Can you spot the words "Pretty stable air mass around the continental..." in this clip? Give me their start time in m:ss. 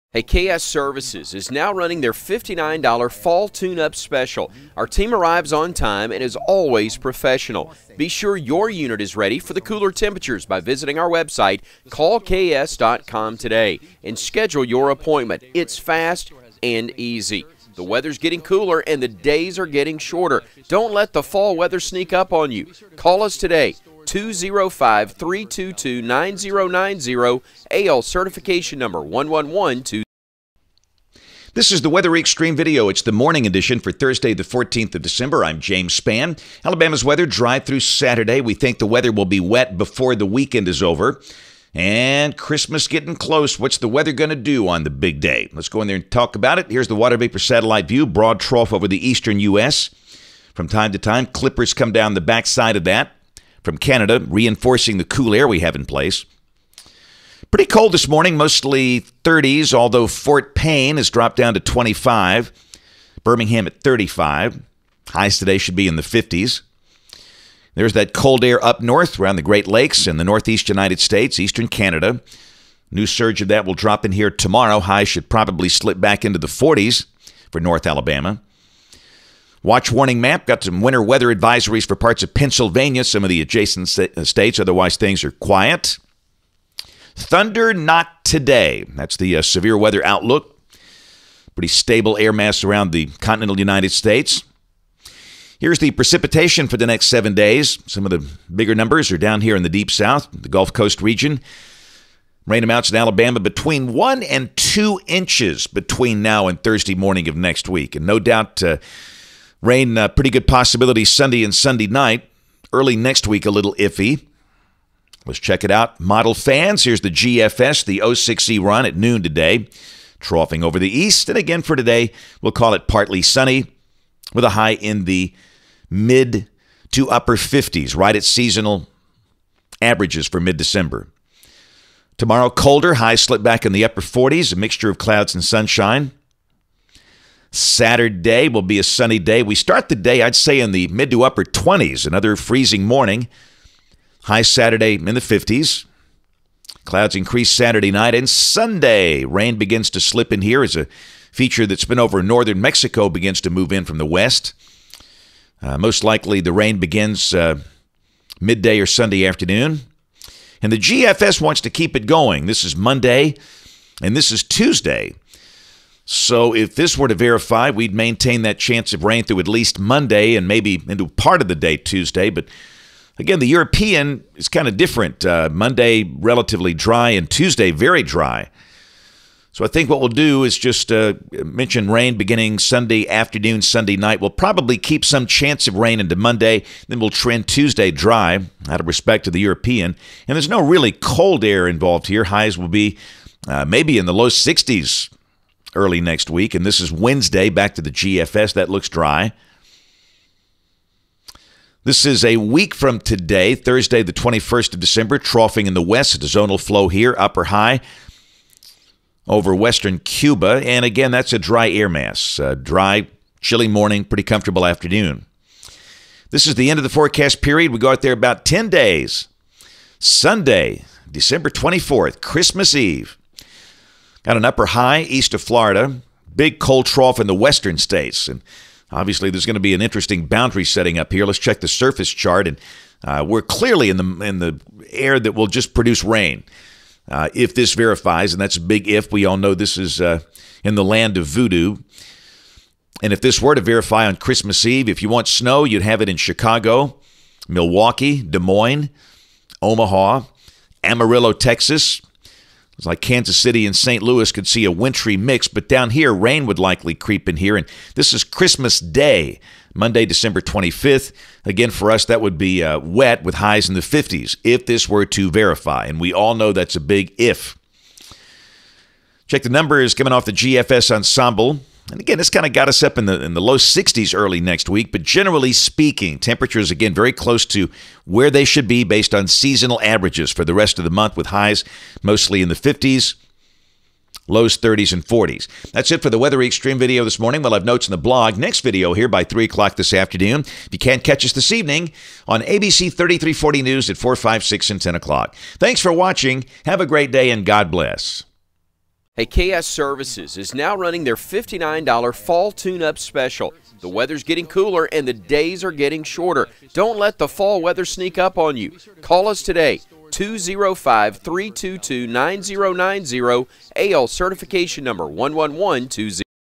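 1:31.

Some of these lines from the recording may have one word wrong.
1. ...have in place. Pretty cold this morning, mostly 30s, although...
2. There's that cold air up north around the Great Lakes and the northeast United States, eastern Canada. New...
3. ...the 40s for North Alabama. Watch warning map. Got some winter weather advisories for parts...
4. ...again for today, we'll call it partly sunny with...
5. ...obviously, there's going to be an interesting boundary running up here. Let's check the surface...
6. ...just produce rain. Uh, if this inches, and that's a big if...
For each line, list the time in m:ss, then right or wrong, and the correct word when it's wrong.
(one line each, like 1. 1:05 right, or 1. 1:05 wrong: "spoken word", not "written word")
1. 0:55 right
2. 1:07 right
3. 1:16 right
4. 2:01 right
5. 3:48 wrong: "setting", not "running"
6. 3:55 wrong: "verifies", not "inches".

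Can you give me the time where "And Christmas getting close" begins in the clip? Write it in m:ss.
0:41.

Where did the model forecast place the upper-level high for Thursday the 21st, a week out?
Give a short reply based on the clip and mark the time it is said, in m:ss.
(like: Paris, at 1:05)
western Cuba, at 3:29.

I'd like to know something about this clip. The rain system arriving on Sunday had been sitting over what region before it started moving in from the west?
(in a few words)
northern Mexico.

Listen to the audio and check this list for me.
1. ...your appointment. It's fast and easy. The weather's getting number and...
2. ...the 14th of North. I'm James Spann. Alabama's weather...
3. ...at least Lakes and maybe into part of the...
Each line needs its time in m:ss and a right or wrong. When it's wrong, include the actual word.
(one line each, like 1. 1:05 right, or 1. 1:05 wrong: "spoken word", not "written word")
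1. 0:14 wrong: "cooler", not "number"
2. 0:34 wrong: "December", not "North"
3. 2:49 wrong: "Monday", not "Lakes".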